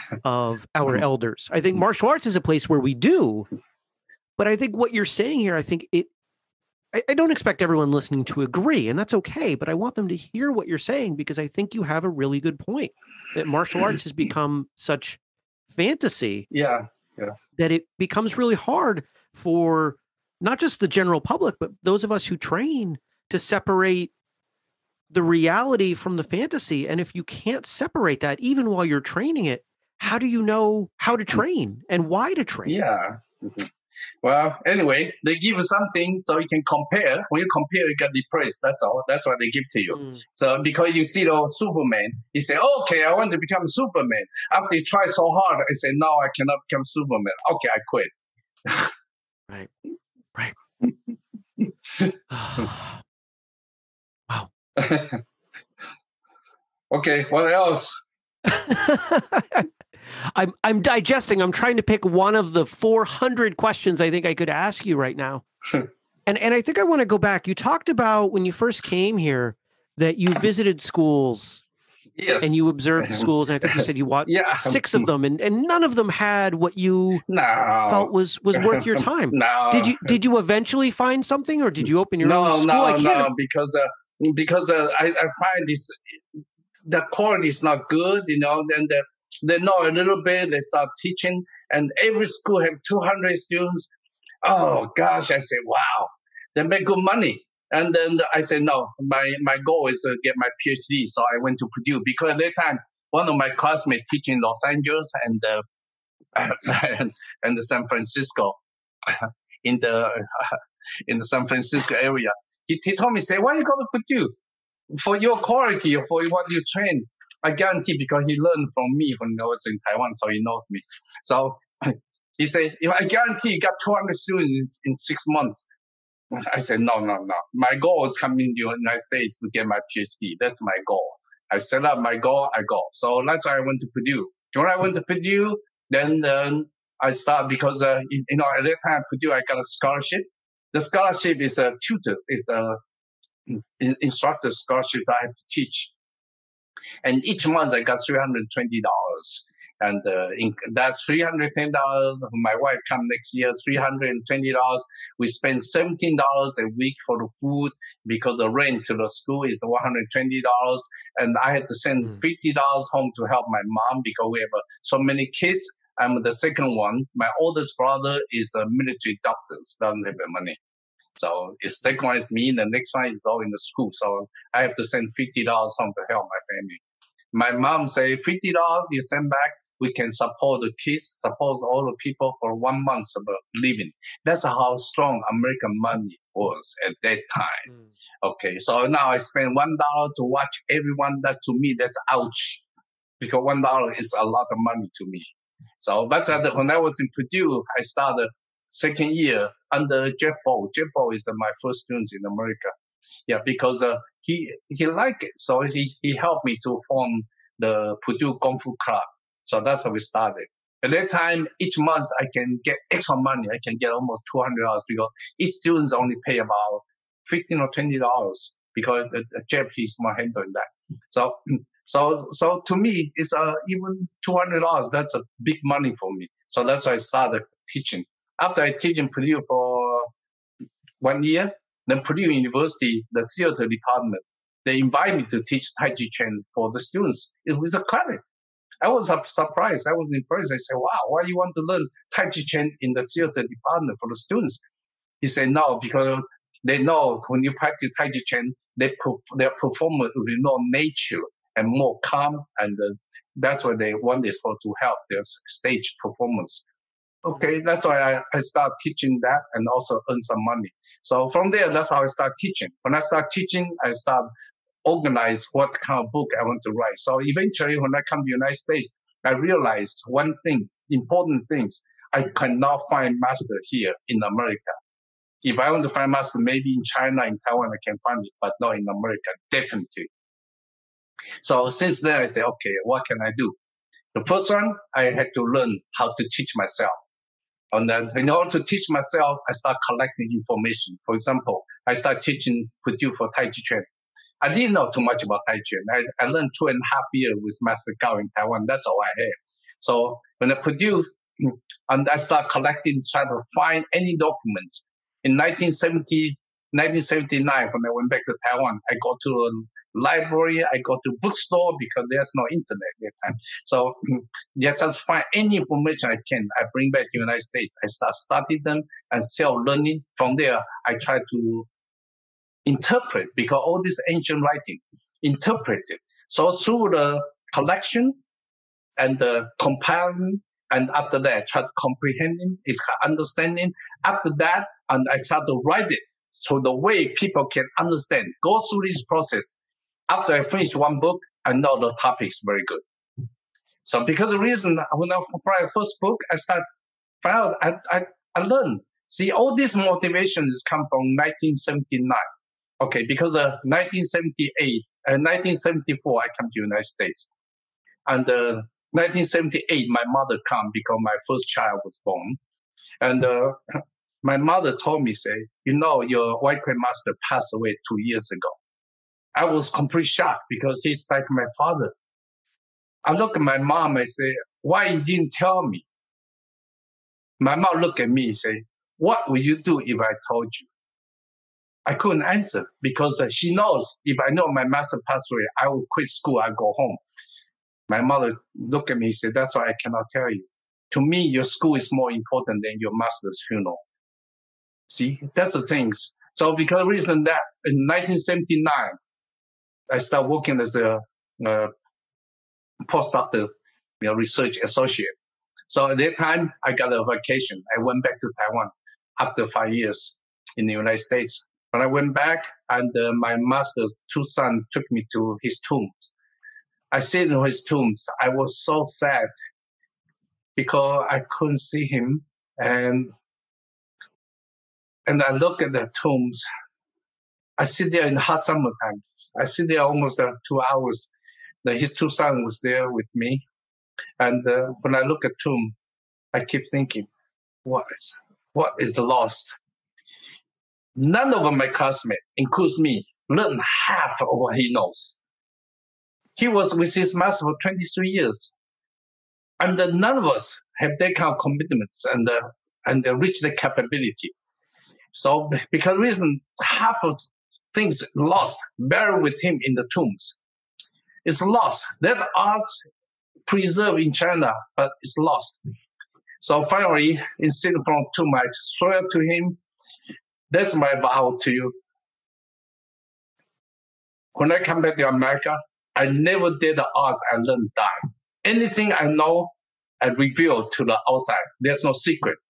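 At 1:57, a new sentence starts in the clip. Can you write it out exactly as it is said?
I guarantee because he learned from me when I was in Taiwan, so he knows me.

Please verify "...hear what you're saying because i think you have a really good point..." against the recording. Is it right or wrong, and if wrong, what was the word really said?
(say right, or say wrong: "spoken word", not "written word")
right.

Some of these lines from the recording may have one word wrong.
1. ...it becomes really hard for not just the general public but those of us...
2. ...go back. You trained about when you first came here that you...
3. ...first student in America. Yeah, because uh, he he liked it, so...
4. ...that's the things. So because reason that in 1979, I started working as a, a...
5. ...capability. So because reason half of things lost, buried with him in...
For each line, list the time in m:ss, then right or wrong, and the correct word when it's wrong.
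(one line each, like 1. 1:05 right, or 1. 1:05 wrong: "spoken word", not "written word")
1. 0:17 right
2. 1:07 wrong: "talked", not "trained"
3. 3:21 right
4. 6:35 right
5. 7:33 right.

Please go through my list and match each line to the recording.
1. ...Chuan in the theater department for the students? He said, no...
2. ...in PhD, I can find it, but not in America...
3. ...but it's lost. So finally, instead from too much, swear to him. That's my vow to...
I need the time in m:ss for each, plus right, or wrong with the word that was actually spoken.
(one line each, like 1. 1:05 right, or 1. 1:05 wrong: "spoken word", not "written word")
1. 4:02 right
2. 4:37 wrong: "Taiwan", not "PhD"
3. 7:44 right.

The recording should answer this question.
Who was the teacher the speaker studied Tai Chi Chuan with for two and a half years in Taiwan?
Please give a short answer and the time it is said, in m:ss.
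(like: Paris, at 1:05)
Master Gao, at 4:57.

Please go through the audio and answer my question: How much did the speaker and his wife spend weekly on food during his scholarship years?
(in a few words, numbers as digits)
$17.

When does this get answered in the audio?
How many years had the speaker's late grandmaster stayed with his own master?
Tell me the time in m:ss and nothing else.
7:27.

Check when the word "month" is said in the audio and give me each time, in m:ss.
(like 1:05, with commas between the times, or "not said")
2:05, 2:27, 3:02, 3:31.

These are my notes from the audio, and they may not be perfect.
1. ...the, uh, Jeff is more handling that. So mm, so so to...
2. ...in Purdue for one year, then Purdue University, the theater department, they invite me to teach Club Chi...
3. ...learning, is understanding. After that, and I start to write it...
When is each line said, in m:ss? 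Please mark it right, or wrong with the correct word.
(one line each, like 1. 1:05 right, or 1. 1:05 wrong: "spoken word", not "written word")
1. 3:39 right
2. 3:48 wrong: "Tai", not "Club"
3. 5:31 wrong: "comprehending", not "learning".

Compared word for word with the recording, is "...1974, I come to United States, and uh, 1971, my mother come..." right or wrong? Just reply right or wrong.
wrong.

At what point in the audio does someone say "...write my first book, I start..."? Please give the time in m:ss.
5:45.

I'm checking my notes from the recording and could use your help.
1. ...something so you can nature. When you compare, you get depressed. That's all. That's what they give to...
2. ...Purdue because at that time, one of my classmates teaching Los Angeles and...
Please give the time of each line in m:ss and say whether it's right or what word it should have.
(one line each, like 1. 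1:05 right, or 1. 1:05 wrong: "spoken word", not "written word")
1. 0:35 wrong: "compare", not "nature"
2. 1:41 right.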